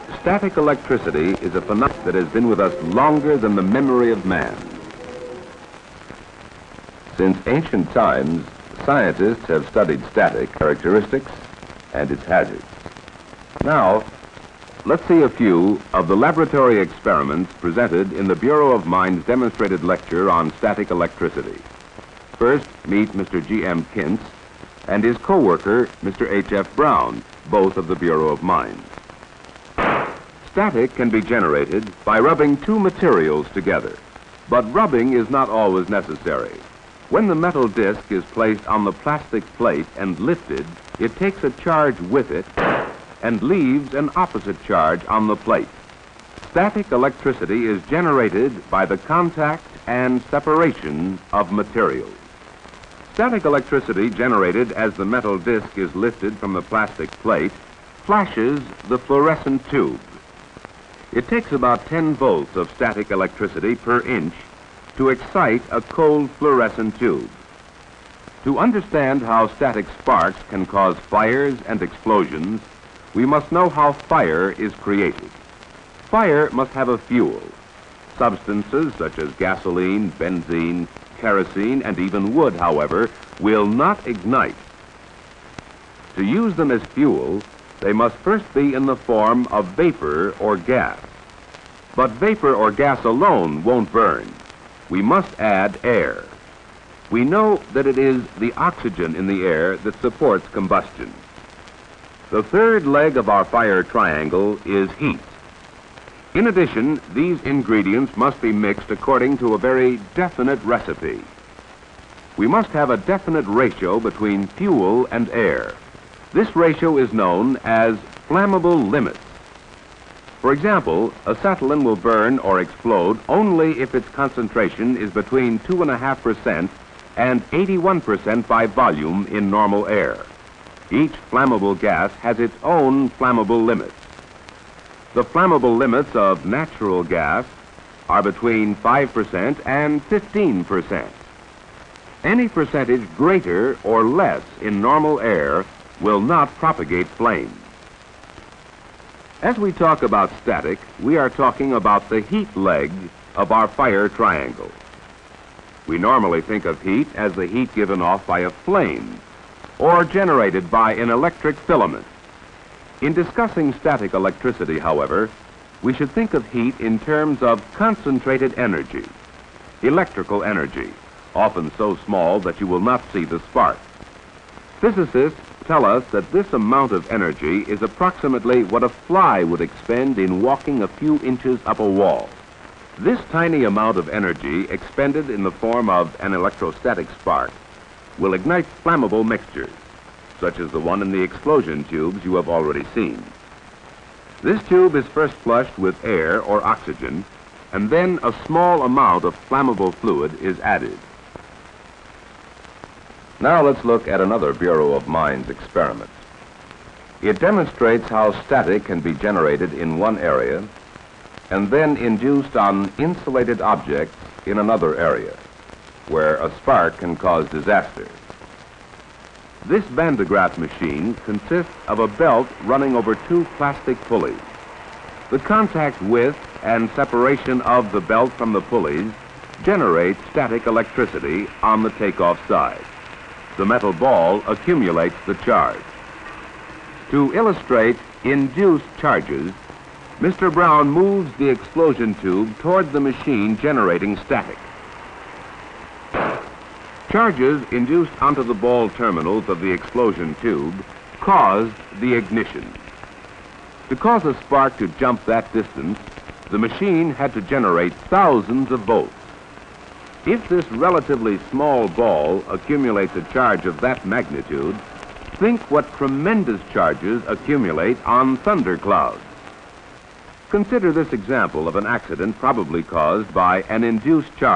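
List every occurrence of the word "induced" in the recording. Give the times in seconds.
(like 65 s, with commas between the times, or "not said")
211 s, 238 s, 247 s, 273 s.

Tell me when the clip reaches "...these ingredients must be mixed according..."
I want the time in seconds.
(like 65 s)
107 s.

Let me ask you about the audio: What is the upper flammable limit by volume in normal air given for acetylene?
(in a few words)
81%.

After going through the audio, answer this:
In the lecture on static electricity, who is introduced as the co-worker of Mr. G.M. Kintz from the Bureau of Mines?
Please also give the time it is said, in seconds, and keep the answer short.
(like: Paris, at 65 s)
H.F. Brown, at 26 s.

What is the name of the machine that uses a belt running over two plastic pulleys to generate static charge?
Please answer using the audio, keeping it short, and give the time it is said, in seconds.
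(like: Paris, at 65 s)
Van de Graaff machine, at 219 s.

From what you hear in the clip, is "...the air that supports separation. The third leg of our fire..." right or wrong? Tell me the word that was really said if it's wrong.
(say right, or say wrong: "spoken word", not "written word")
wrong: "combustion", not "separation".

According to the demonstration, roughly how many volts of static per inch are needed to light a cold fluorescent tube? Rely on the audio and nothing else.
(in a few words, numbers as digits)
10 volts.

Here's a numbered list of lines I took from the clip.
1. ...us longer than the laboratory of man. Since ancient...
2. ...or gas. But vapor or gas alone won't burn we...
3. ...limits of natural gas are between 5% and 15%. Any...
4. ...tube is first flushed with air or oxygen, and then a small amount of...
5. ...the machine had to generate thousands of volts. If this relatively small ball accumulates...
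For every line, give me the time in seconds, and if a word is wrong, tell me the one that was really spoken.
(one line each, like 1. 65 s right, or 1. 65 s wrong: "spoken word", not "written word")
1. 2 s wrong: "memory", not "laboratory"
2. 90 s right
3. 135 s right
4. 194 s right
5. 256 s right.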